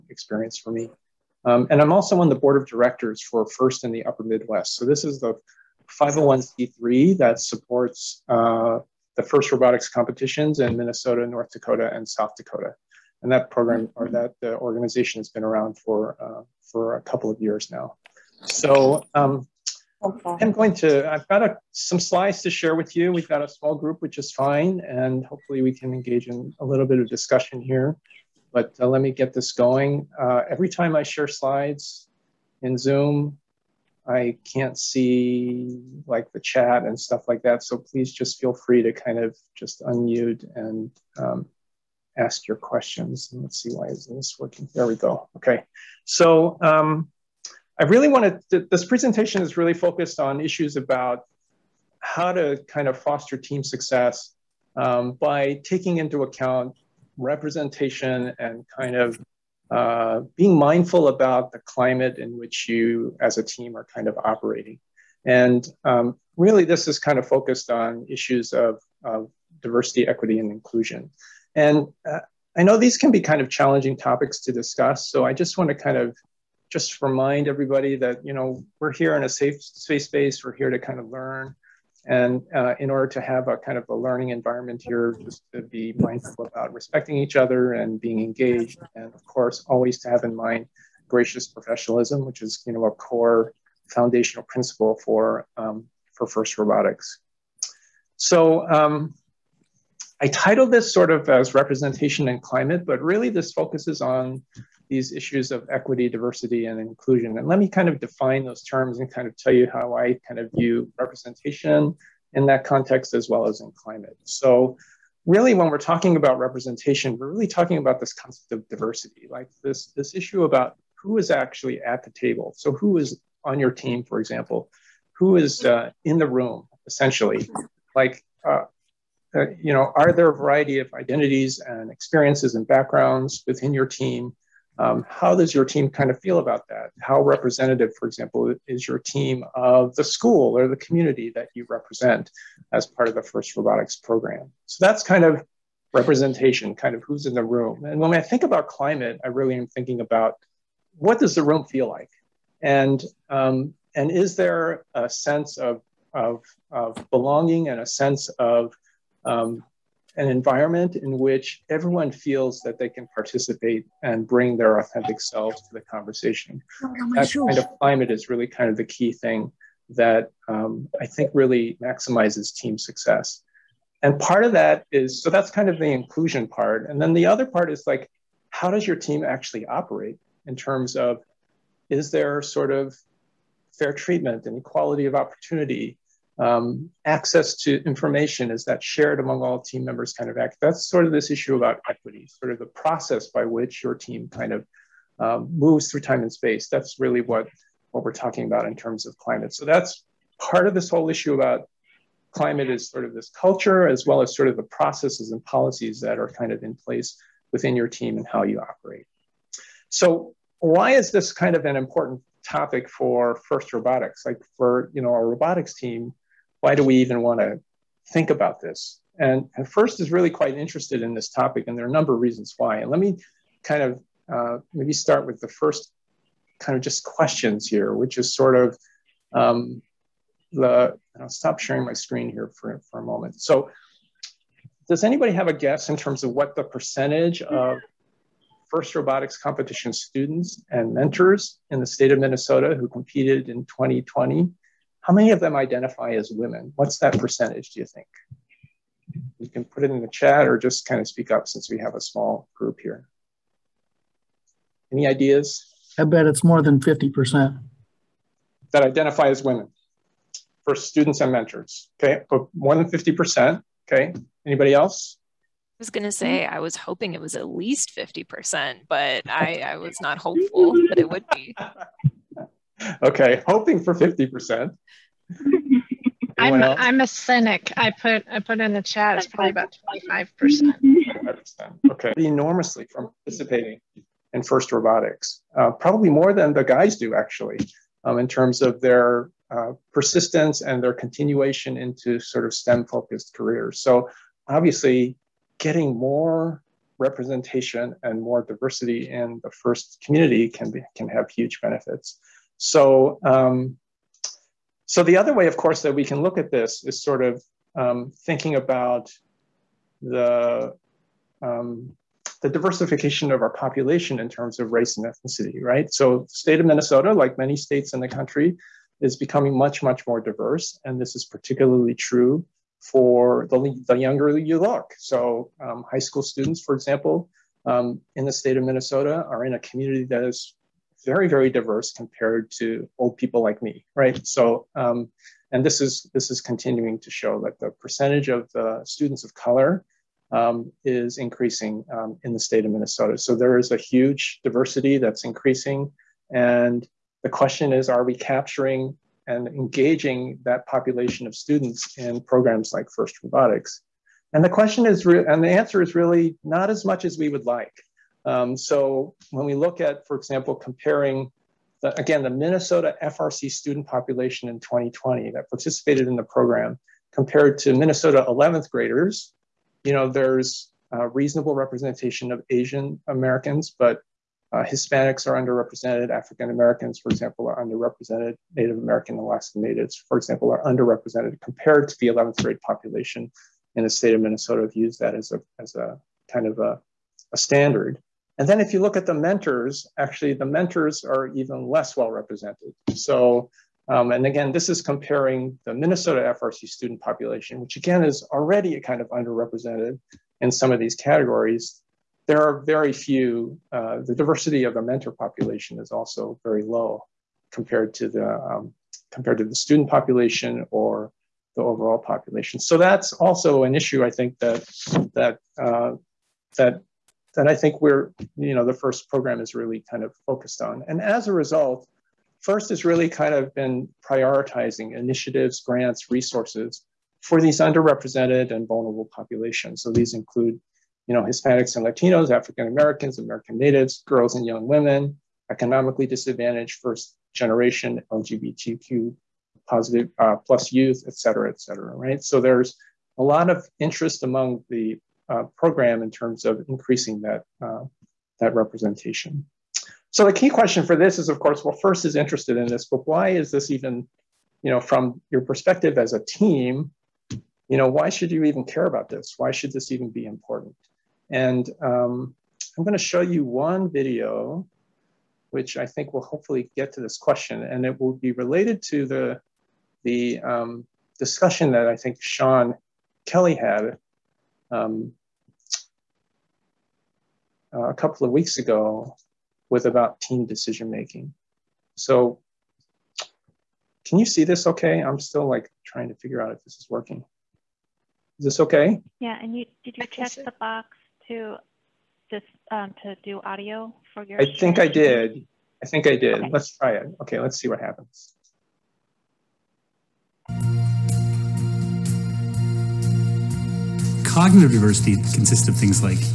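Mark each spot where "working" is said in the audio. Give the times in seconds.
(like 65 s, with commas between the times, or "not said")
44 s, 486 s.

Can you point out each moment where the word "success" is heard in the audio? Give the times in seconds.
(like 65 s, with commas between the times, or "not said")
53 s, 172 s.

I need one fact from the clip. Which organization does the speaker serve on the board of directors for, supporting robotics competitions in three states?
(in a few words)
First in the Upper Midwest.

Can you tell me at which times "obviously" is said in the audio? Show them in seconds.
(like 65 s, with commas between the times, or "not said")
294 s.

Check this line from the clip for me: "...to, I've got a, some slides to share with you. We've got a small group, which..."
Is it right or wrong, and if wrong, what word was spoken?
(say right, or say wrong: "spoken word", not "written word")
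right.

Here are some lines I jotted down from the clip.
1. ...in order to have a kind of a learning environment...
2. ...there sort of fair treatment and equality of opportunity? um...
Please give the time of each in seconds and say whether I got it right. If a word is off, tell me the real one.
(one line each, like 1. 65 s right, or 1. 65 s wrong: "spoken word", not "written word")
1. 82 s right
2. 182 s right.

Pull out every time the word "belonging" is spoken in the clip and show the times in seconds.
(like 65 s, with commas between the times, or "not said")
157 s.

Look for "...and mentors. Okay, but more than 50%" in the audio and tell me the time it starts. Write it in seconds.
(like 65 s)
261 s.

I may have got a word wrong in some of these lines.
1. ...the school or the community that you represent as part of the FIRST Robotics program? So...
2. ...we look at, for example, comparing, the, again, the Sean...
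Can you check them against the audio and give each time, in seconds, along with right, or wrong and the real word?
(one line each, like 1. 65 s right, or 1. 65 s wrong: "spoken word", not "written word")
1. 139 s right
2. 359 s wrong: "Minnesota", not "Sean".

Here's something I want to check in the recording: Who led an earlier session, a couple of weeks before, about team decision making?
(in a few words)
Sean Kelly.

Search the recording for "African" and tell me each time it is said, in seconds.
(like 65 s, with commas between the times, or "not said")
376 s, 432 s.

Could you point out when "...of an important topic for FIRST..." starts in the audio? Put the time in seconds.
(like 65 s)
211 s.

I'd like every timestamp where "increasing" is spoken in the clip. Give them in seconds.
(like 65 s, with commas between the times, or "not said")
341 s, 345 s, 446 s.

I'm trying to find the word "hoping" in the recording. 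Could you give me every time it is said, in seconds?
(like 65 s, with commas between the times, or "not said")
266 s, 273 s.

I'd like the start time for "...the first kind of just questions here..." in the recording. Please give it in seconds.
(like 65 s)
225 s.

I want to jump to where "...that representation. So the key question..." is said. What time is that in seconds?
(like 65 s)
448 s.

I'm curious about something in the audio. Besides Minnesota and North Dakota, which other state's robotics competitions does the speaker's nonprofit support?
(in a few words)
South Dakota.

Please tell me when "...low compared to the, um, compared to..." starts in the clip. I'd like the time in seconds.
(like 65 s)
406 s.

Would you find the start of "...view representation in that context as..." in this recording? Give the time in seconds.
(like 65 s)
110 s.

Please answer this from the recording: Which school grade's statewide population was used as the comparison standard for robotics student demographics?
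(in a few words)
11th grade.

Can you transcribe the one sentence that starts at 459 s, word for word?
Why should this even be important?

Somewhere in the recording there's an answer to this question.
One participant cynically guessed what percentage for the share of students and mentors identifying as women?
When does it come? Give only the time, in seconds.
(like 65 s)
280 s.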